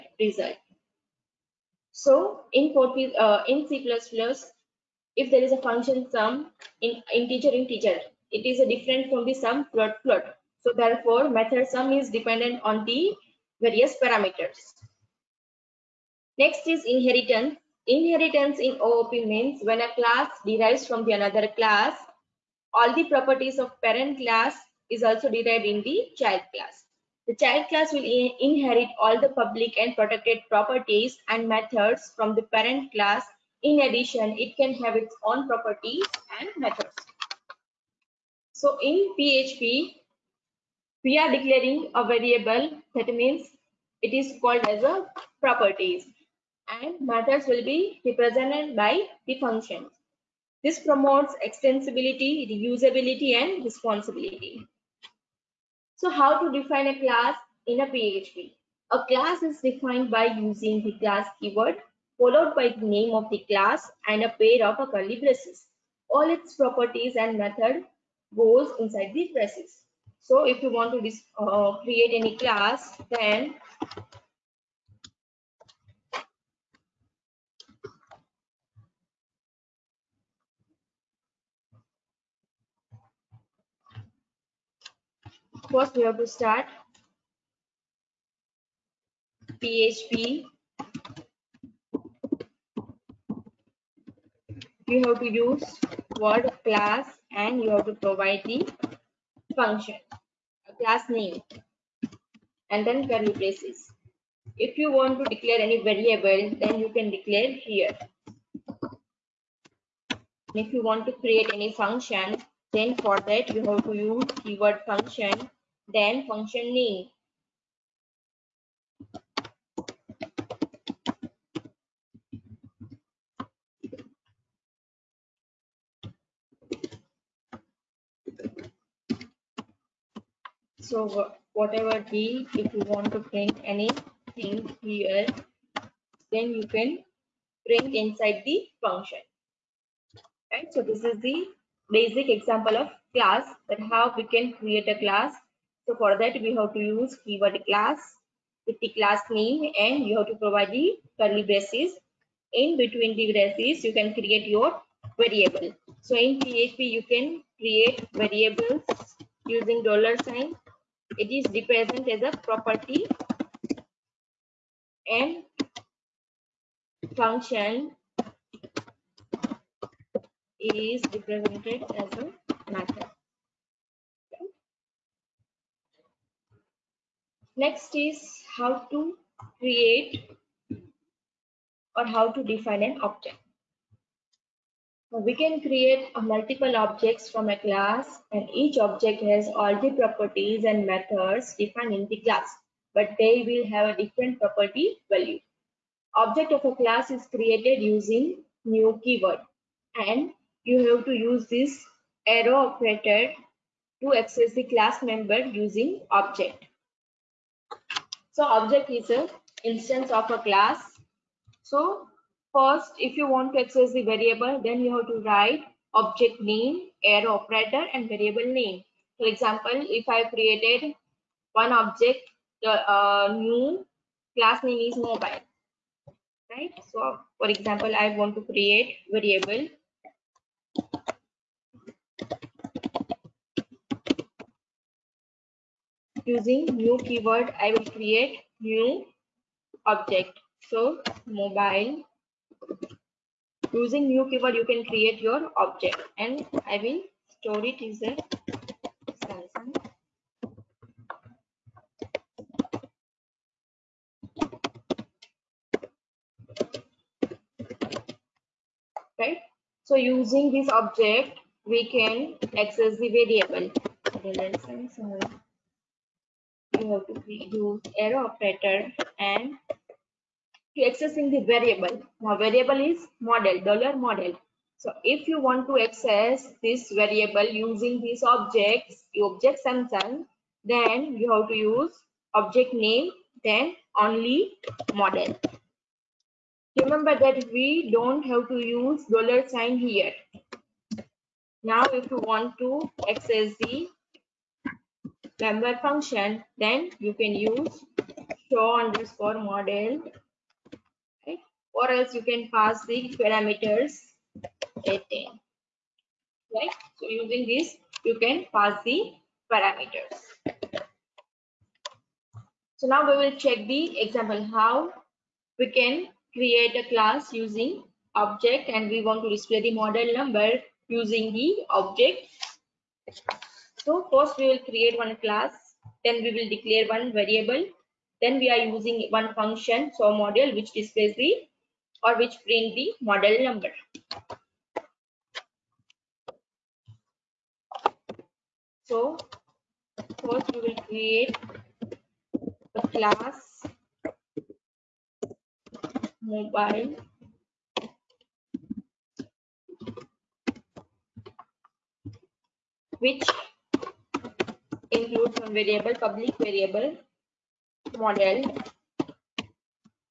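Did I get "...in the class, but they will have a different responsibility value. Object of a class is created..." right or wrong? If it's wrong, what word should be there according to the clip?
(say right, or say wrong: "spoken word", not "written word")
wrong: "property", not "responsibility".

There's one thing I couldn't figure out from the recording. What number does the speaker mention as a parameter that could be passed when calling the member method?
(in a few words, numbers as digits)
18.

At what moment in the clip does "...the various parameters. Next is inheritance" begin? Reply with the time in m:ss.
0:12.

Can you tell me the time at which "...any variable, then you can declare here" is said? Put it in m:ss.
1:45.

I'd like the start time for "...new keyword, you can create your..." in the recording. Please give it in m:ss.
4:04.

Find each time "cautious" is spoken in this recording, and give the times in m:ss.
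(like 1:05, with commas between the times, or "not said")
not said.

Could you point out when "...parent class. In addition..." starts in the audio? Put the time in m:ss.
0:32.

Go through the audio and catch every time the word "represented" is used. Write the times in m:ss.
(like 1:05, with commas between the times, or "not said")
0:48, 2:41, 2:51.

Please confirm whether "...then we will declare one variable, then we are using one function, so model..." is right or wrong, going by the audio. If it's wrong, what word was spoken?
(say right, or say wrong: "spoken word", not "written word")
right.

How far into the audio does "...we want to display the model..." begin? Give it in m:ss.
5:18.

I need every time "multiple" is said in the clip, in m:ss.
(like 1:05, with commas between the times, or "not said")
3:06.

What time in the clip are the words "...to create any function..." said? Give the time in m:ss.
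1:51.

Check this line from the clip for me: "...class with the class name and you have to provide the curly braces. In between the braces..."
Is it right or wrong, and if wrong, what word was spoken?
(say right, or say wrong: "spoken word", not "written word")
right.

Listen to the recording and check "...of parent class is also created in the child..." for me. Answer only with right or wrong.
wrong.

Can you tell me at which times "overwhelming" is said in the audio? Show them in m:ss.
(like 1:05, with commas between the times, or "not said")
not said.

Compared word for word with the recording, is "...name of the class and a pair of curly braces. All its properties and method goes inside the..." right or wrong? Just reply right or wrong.
right.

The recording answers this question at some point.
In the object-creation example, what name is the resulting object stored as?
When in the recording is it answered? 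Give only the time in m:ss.
4:09.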